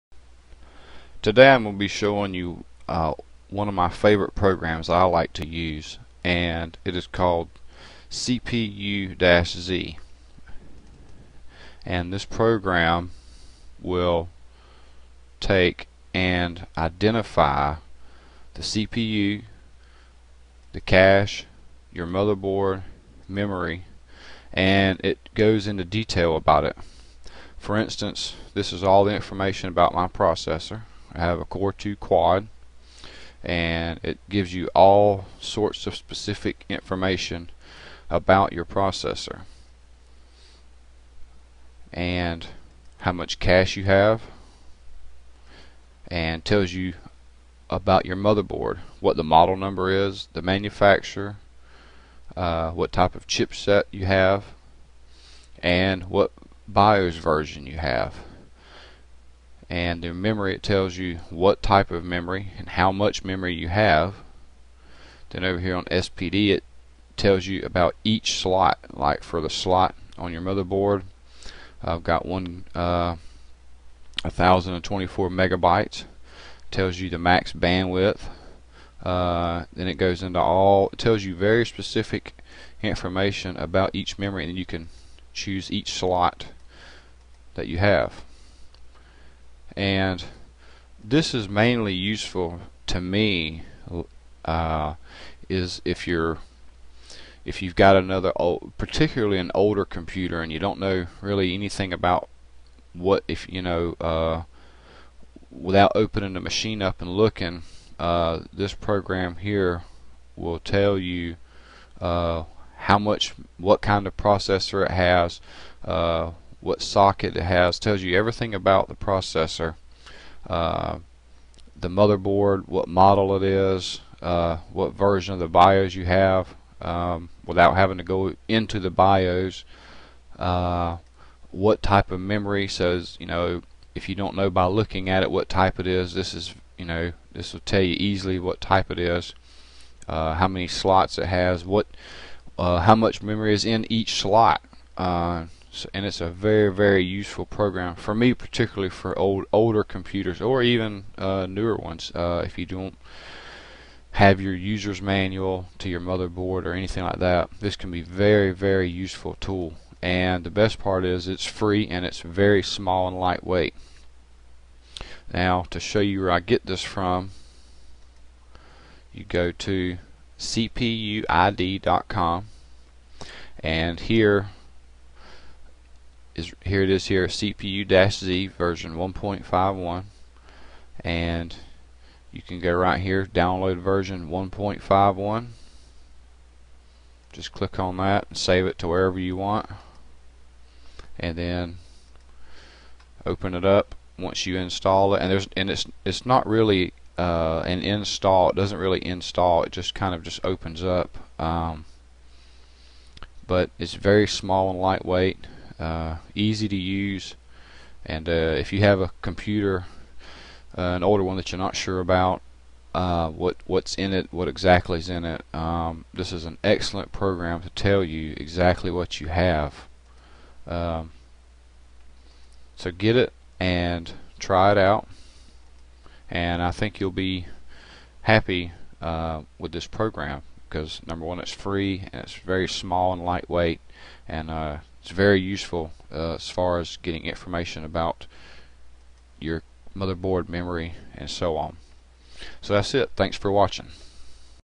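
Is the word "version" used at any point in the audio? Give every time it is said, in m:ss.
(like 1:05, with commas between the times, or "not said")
0:57, 2:04, 2:58, 3:03.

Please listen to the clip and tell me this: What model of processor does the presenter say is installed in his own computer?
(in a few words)
Core 2 Quad.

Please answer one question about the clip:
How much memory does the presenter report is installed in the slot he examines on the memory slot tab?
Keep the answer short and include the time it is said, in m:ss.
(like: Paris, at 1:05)
1024 megabytes, at 1:14.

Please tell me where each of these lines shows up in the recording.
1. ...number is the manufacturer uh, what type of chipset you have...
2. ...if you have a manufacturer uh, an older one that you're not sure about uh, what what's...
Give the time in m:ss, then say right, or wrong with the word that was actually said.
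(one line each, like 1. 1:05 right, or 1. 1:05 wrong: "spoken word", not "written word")
1. 0:49 right
2. 3:28 wrong: "computer", not "manufacturer".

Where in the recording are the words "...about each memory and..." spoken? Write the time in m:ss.
1:23.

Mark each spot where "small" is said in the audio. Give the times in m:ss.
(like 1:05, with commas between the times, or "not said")
2:42, 3:24, 3:52.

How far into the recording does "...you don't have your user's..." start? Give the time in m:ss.
2:32.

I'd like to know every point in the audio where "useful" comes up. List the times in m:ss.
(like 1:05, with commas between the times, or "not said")
1:31, 2:27, 2:38, 3:55.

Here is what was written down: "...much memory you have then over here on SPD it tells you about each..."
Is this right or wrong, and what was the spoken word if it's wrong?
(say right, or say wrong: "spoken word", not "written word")
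right.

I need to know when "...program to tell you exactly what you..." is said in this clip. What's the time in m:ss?
3:37.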